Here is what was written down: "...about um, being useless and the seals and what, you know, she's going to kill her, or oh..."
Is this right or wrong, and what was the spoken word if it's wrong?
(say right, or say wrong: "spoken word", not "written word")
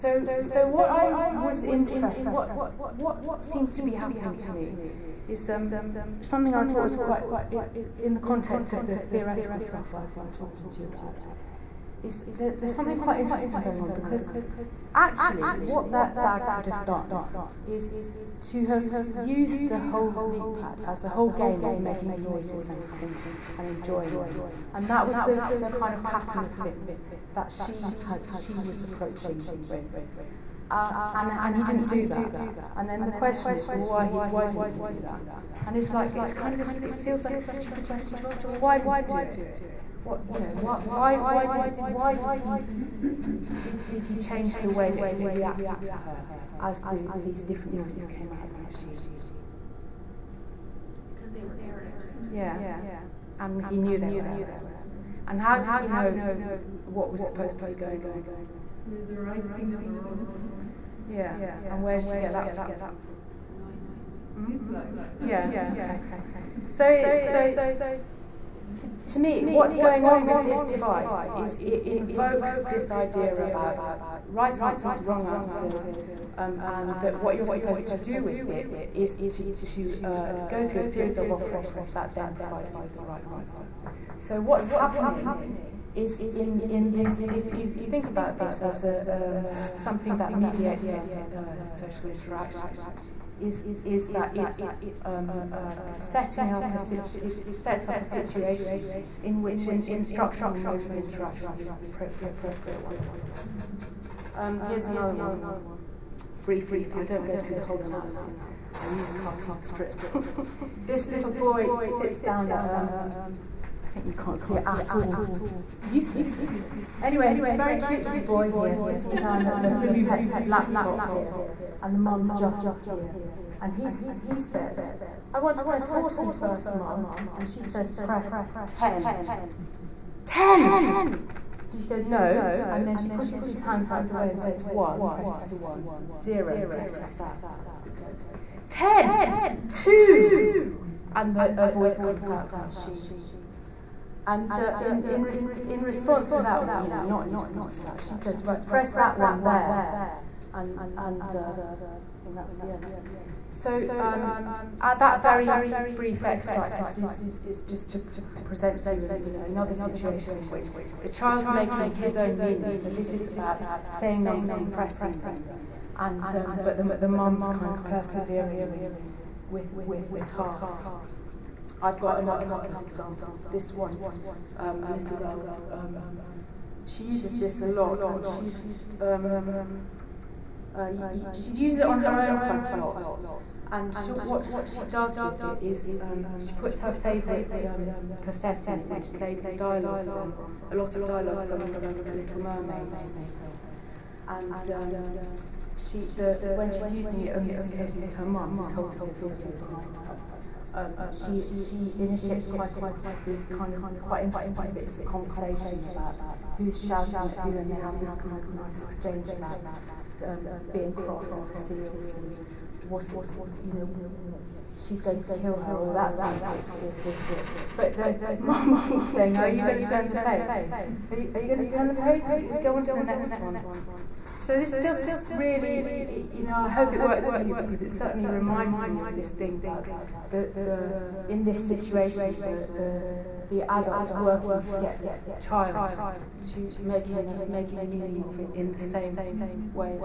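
wrong: "cross", not "useless".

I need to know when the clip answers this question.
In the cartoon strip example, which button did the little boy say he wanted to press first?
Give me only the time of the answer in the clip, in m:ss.
2:05.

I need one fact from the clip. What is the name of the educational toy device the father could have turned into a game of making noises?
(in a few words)
LeapPad.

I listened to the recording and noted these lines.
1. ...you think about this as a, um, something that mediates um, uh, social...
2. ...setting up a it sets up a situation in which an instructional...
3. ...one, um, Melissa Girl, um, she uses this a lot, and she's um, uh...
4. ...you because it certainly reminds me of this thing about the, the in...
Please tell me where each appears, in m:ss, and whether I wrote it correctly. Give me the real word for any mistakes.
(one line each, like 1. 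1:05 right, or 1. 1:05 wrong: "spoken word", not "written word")
1. 1:27 right
2. 1:35 right
3. 2:53 right
4. 3:47 right.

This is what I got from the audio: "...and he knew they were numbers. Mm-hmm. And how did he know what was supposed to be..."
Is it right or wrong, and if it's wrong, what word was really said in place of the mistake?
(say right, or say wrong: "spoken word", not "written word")
wrong: "errors", not "numbers".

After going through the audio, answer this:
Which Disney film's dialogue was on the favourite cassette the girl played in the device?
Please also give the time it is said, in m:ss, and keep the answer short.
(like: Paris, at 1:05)
The Little Mermaid, at 3:12.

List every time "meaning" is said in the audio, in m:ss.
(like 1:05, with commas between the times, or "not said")
2:42, 3:57.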